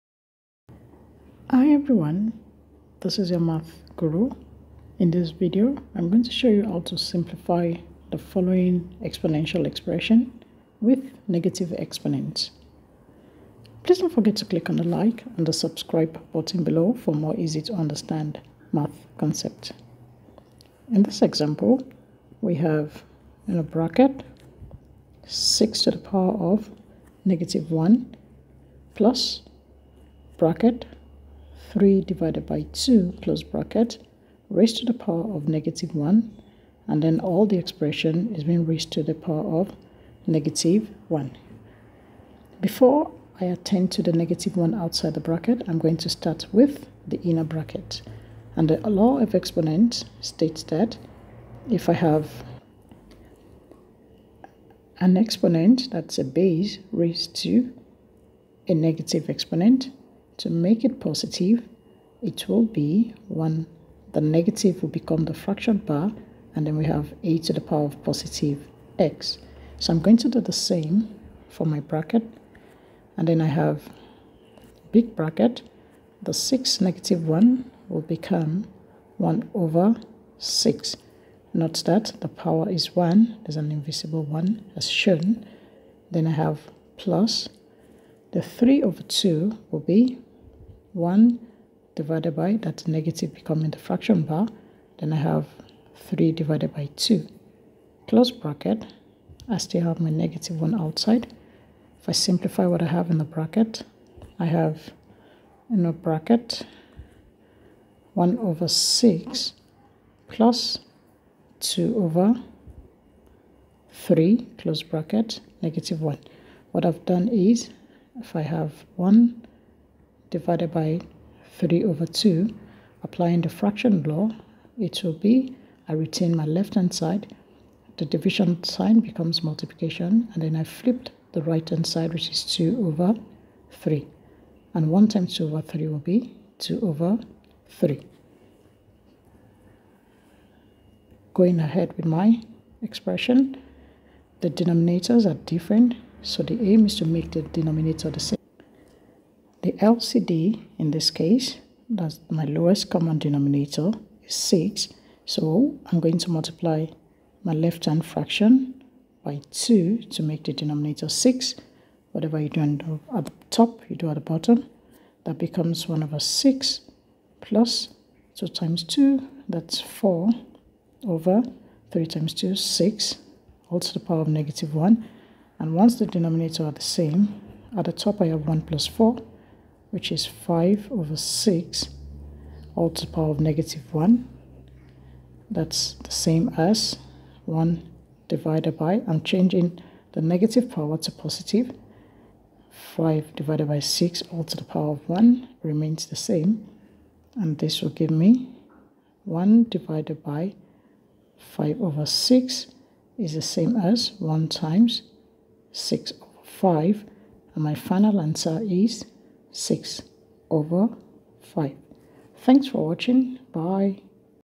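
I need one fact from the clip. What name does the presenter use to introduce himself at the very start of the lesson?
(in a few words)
math guru.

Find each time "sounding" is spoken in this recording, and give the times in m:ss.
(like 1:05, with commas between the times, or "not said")
not said.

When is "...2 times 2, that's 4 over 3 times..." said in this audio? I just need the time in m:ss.
2:48.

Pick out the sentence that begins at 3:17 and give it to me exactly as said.
And this will give me 1 divided by 5 over 6 is the same as 1 times 6 over 5.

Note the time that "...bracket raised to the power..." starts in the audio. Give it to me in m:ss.
0:33.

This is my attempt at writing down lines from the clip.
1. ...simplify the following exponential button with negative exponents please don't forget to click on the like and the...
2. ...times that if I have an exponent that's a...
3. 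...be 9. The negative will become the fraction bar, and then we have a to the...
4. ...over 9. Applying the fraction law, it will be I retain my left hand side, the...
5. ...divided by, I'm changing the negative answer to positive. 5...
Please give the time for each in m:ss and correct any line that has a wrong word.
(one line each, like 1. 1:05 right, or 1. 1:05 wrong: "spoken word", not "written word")
1. 0:06 wrong: "expression", not "button"
2. 0:50 wrong: "states", not "times"
3. 1:02 wrong: "1", not "9"
4. 2:01 wrong: "2", not "9"
5. 3:08 wrong: "power", not "answer".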